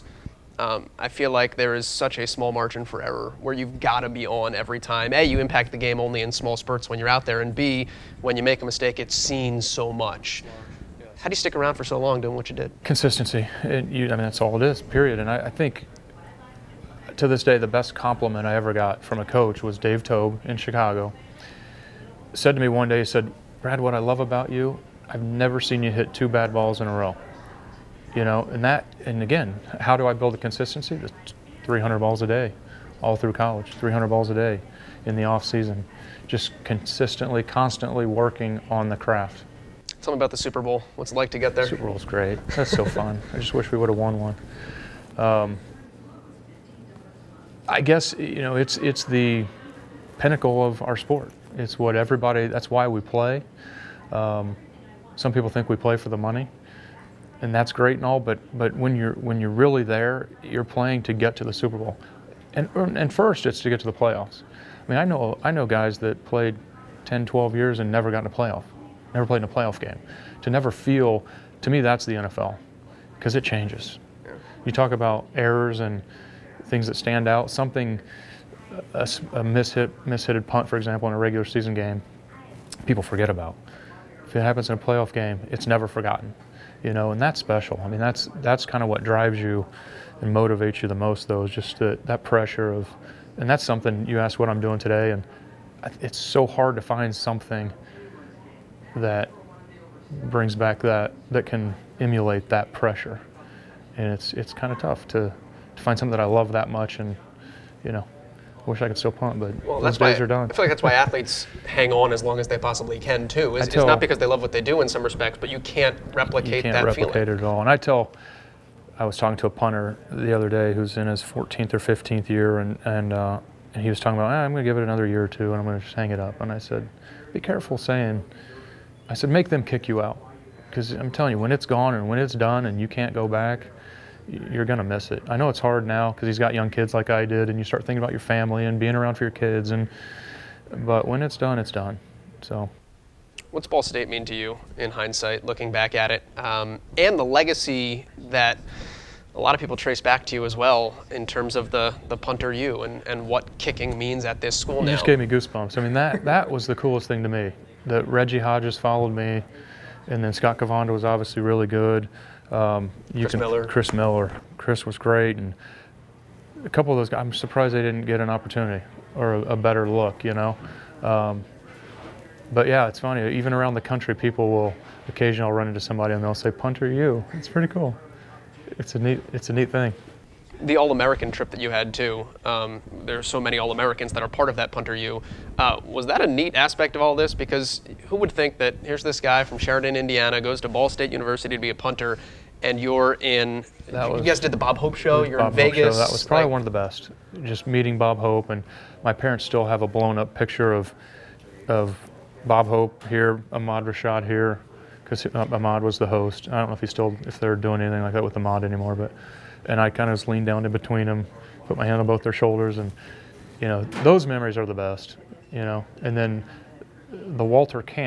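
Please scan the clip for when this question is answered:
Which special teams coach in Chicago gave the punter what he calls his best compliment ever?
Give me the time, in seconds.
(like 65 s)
19 s.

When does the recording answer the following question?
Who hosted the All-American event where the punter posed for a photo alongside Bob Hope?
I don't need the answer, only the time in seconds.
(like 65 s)
203 s.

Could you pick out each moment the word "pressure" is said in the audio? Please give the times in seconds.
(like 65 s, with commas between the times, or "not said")
92 s, 102 s.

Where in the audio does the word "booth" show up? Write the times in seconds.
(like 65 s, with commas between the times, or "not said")
not said.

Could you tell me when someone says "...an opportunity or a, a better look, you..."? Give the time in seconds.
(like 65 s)
168 s.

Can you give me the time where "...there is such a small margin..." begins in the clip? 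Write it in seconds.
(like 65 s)
1 s.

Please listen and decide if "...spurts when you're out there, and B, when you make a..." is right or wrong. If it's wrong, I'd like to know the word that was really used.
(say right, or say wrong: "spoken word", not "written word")
right.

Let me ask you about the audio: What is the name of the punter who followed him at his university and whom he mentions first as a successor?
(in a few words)
Reggie Hodges.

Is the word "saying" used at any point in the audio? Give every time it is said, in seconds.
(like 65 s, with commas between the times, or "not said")
127 s.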